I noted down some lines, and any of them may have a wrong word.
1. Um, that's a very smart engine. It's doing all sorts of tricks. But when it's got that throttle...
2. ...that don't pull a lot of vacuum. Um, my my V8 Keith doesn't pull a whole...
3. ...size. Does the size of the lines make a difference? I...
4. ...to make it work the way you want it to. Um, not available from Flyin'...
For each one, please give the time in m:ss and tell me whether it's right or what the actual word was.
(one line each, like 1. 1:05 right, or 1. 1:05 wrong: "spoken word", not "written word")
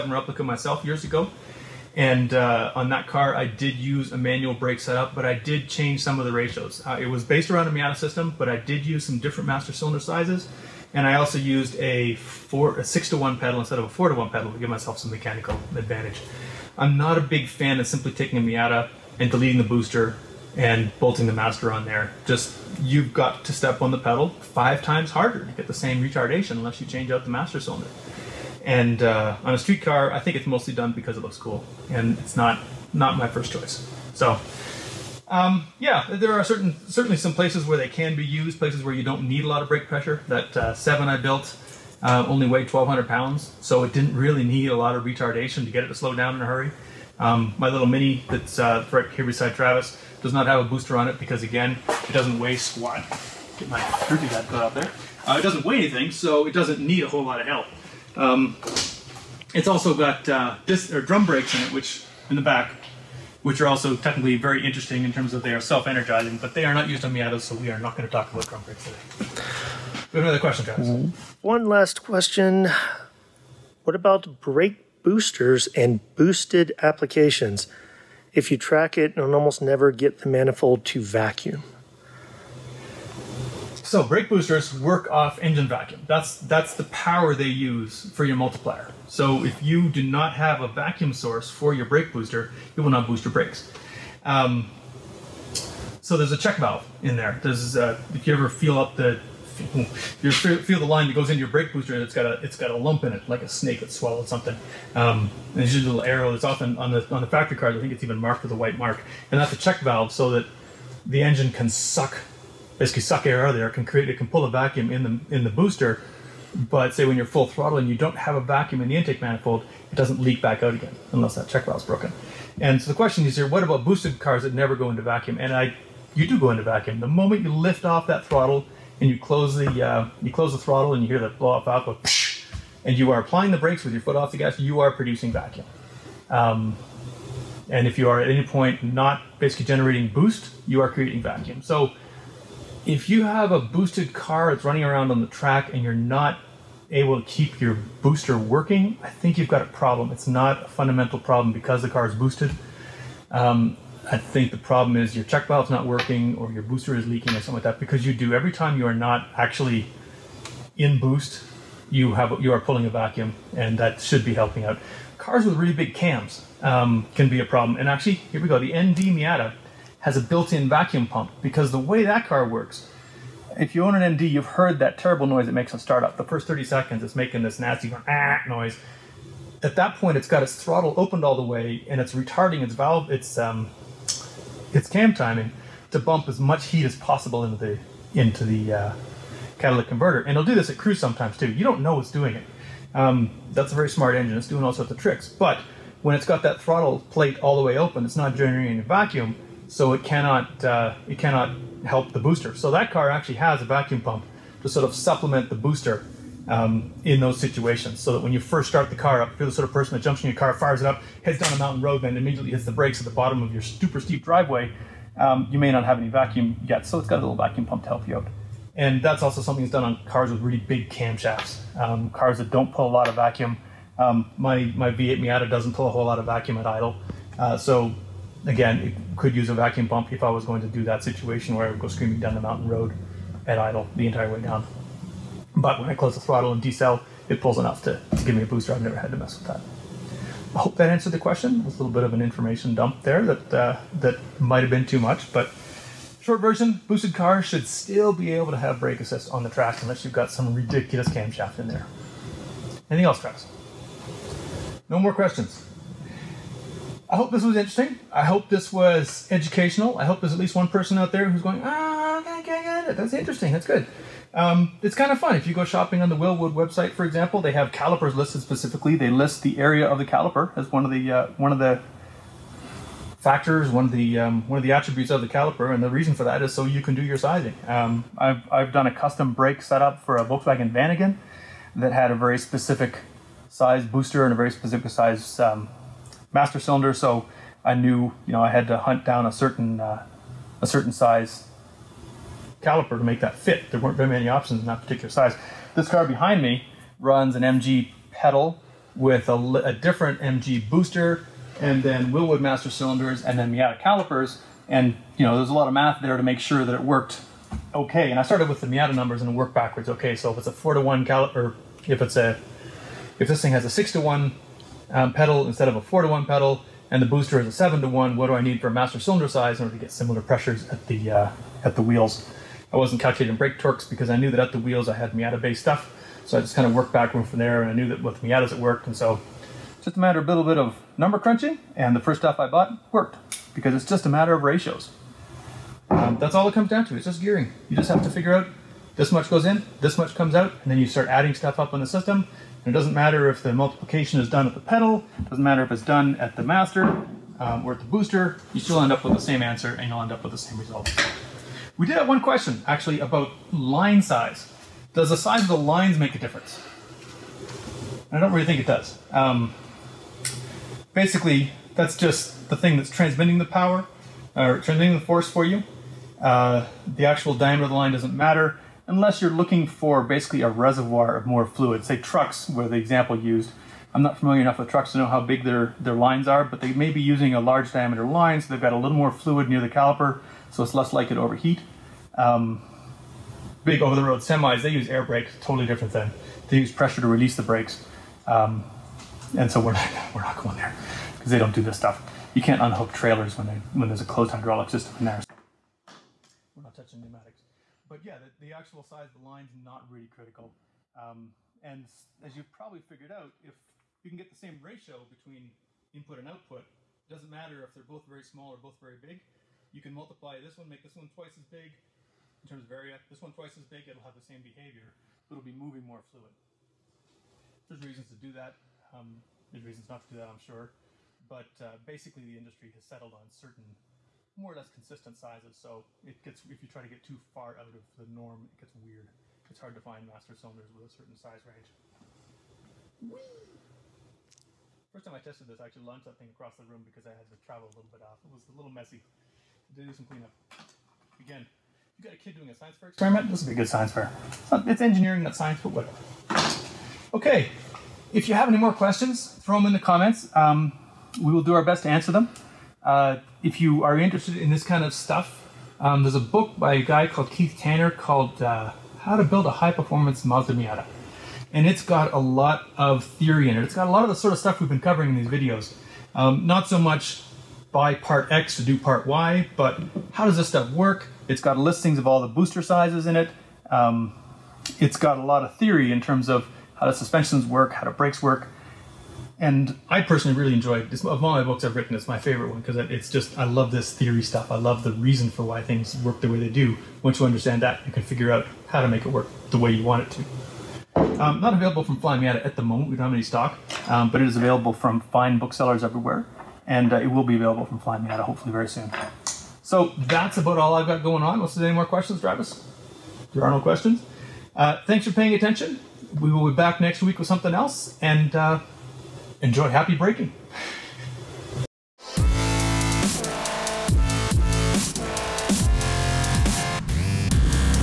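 1. 3:12 right
2. 3:42 wrong: "Miata", not "Keith"
3. 5:54 right
4. 8:08 right.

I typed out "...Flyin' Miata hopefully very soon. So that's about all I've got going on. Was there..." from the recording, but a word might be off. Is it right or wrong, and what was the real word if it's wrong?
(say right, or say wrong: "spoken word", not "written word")
right.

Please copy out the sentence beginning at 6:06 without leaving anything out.
Uh, the actual diameter of the line doesn't matter unless you're looking for basically a reservoir of more fluid.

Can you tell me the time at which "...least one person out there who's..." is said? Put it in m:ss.
4:20.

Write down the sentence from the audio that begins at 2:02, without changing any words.
And so the question is here: What about boosted cars that never go into vacuum?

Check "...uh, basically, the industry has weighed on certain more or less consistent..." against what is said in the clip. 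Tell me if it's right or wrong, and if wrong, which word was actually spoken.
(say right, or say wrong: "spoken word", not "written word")
wrong: "settled", not "weighed".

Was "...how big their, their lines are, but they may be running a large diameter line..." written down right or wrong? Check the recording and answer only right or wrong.
wrong.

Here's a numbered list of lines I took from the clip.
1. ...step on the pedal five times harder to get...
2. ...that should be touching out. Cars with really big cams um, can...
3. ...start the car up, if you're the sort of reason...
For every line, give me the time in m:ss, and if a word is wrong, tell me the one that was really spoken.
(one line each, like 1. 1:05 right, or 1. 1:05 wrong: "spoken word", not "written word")
1. 0:23 right
2. 2:43 wrong: "helping", not "touching"
3. 3:28 wrong: "person", not "reason".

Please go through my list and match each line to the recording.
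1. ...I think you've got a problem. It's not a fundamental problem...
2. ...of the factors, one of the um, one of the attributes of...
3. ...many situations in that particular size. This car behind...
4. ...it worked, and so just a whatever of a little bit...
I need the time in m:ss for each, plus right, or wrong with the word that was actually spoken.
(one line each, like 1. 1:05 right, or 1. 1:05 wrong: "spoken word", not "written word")
1. 2:29 right
2. 4:31 right
3. 4:54 wrong: "options", not "situations"
4. 5:28 wrong: "matter", not "whatever".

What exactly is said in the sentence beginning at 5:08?
And I started with the Miata numbers and worked backwards.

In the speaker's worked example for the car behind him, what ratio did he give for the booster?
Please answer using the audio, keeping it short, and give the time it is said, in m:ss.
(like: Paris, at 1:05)
7 to 1, at 5:17.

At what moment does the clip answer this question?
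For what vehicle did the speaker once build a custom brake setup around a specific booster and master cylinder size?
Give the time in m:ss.
4:40.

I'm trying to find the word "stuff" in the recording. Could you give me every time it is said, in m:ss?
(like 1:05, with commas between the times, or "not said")
5:25, 5:32, 5:41, 6:31, 7:34, 7:44, 7:50, 8:04.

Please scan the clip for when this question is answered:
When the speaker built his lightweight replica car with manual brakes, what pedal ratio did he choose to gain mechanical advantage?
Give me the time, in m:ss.
0:12.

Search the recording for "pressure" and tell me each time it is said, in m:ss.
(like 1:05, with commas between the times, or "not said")
0:39, 5:20, 6:26.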